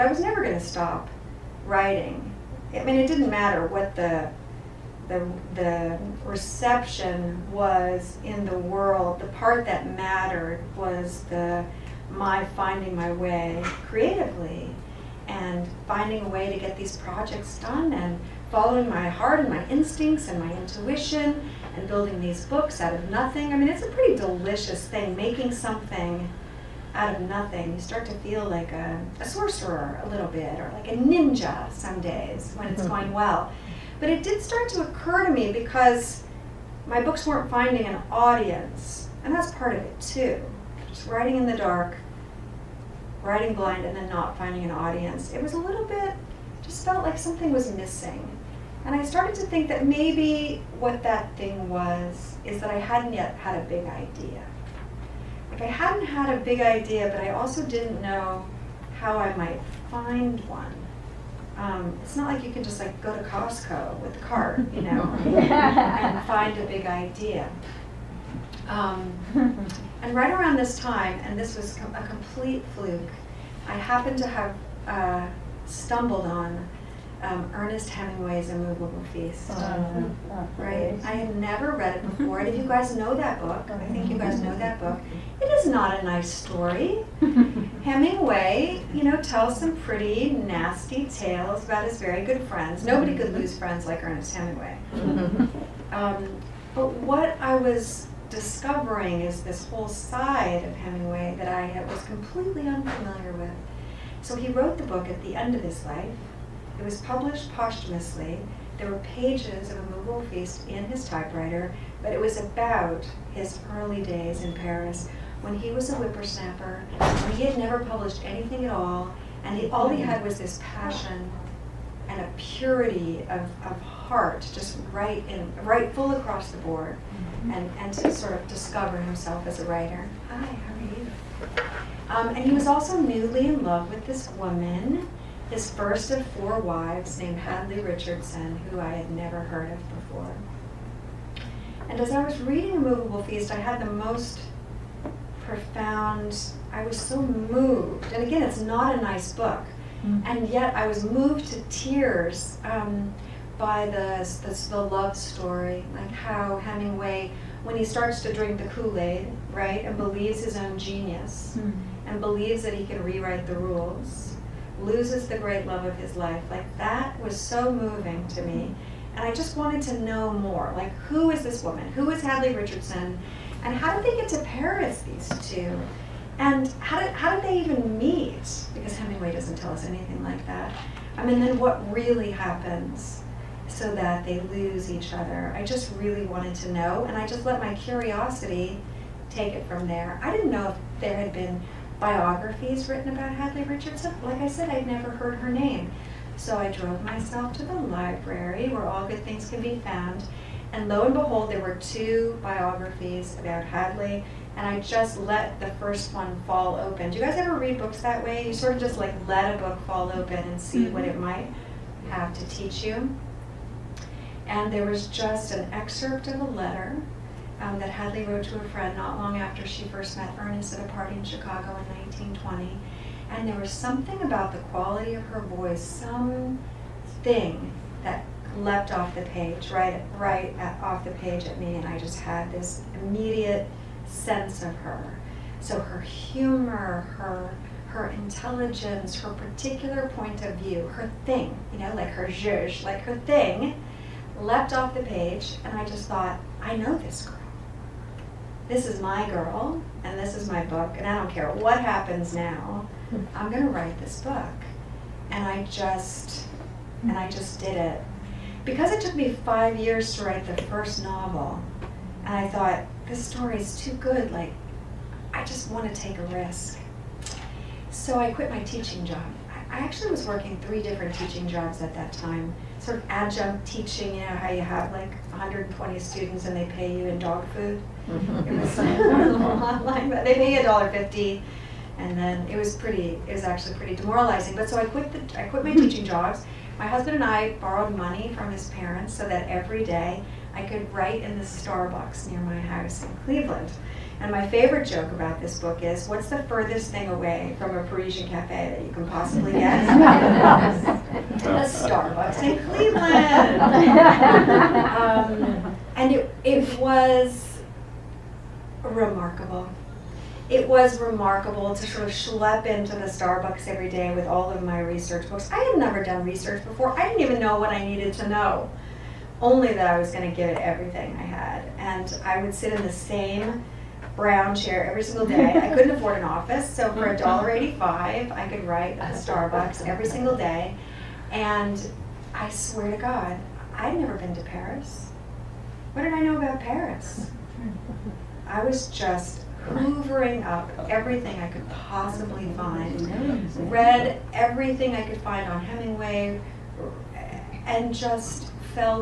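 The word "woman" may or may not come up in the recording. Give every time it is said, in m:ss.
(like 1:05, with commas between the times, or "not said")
2:14, 2:51.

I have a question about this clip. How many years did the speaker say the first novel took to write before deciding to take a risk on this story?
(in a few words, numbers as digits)
5.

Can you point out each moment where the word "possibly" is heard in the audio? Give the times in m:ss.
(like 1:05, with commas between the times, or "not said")
4:59, 5:41.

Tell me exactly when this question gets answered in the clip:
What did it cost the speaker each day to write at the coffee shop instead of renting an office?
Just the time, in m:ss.
5:27.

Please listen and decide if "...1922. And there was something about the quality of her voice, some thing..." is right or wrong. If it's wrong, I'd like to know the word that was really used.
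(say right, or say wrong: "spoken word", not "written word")
wrong: "1920", not "1922".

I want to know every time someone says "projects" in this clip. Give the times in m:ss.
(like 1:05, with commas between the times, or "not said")
0:16.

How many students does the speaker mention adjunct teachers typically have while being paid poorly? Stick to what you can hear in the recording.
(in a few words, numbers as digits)
120.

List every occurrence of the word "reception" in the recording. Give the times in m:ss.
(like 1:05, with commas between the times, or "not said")
0:06.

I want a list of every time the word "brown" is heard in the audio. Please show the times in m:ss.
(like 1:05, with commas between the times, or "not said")
5:24.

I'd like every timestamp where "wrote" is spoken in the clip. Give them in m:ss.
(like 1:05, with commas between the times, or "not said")
1:44, 3:38.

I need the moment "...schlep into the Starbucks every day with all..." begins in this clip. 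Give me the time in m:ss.
5:12.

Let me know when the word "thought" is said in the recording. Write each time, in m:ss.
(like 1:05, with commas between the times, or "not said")
4:06, 4:22.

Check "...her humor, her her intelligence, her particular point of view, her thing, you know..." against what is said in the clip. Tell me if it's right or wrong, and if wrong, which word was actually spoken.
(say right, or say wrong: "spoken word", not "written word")
right.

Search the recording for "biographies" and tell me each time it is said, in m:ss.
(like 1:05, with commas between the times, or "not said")
3:11, 3:22.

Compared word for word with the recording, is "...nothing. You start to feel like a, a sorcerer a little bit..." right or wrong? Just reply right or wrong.
right.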